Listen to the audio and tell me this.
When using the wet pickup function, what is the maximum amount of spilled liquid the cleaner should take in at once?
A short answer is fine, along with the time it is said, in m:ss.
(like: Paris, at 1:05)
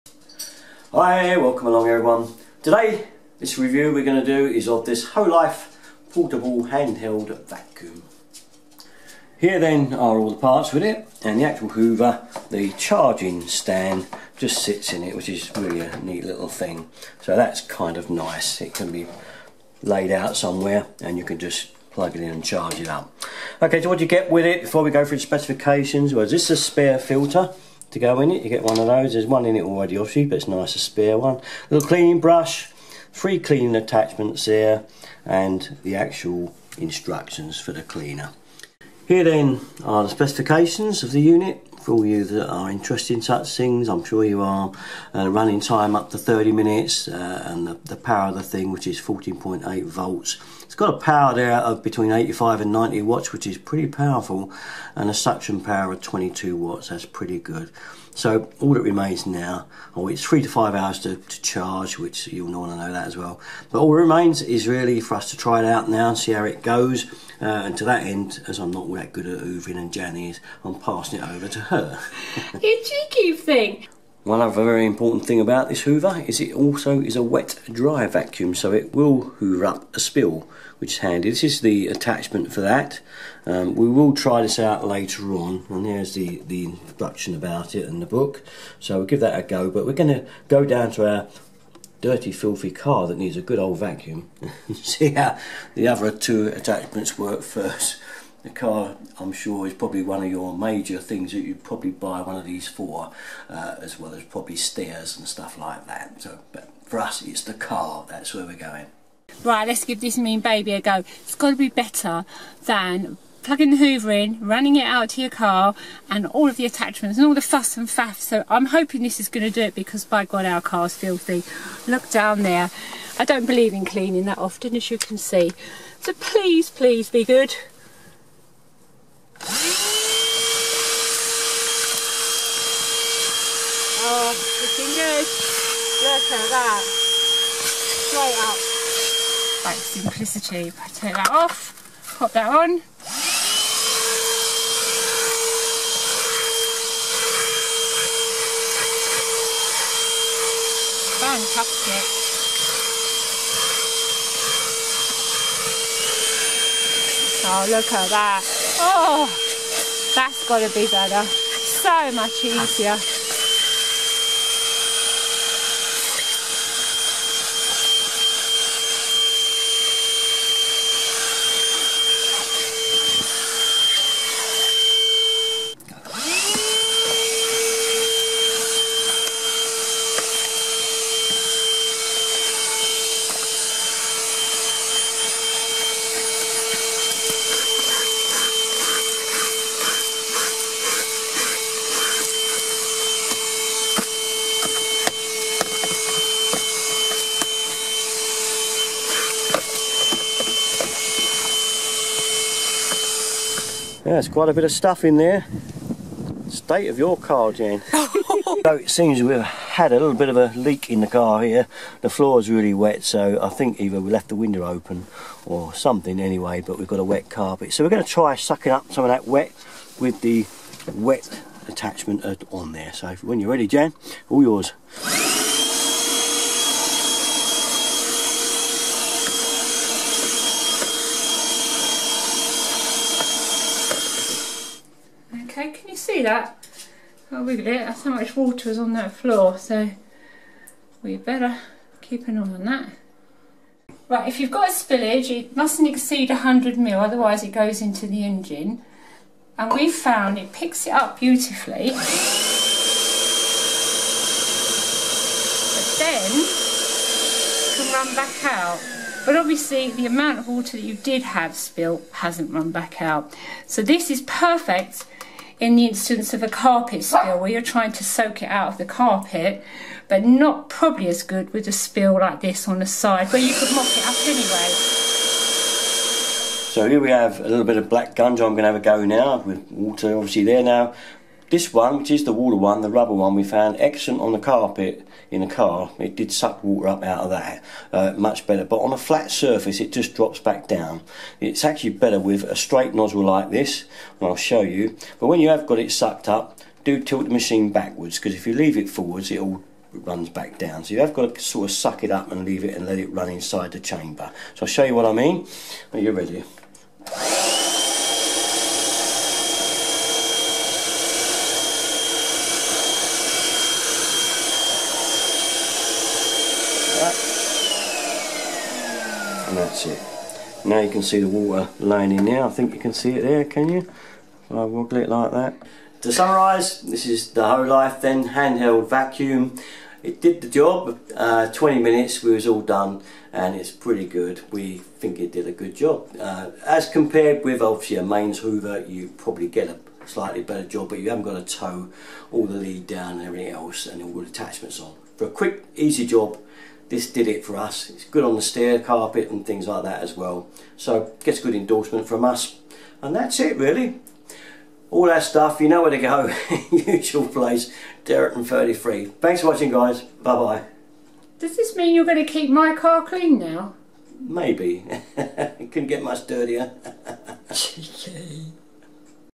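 100 ml, at 4:06.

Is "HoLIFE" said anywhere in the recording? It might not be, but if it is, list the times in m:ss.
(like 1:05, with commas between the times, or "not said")
0:05, 5:27.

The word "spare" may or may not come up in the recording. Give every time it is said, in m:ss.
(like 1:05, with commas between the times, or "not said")
0:26, 0:30.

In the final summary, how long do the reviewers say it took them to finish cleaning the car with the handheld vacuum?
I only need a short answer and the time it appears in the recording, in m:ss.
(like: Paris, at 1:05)
20 minutes, at 5:31.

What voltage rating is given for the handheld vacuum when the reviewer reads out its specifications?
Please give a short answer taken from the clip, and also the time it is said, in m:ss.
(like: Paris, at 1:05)
14.8 volts, at 0:49.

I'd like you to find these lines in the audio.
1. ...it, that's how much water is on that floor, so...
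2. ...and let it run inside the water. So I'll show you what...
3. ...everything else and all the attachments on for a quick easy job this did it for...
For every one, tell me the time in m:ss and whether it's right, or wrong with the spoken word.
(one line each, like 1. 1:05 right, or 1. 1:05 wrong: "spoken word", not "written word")
1. 3:57 right
2. 5:02 wrong: "chamber", not "water"
3. 5:43 right.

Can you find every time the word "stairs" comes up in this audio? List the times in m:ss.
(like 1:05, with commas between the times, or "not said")
1:44, 5:48.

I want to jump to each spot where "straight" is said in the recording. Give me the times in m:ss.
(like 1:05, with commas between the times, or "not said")
2:16, 4:52.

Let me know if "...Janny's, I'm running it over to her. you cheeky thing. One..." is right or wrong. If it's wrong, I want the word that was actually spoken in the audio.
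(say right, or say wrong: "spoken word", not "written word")
wrong: "passing", not "running".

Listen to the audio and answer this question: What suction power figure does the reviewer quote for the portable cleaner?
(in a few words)
22 watts.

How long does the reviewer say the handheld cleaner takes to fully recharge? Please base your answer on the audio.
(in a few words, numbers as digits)
3 to 5 hours.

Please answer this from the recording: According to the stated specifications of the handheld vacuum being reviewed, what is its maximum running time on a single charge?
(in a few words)
30 minutes.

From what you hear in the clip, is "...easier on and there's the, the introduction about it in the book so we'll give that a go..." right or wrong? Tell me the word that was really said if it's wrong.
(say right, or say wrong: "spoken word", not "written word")
wrong: "later", not "easier".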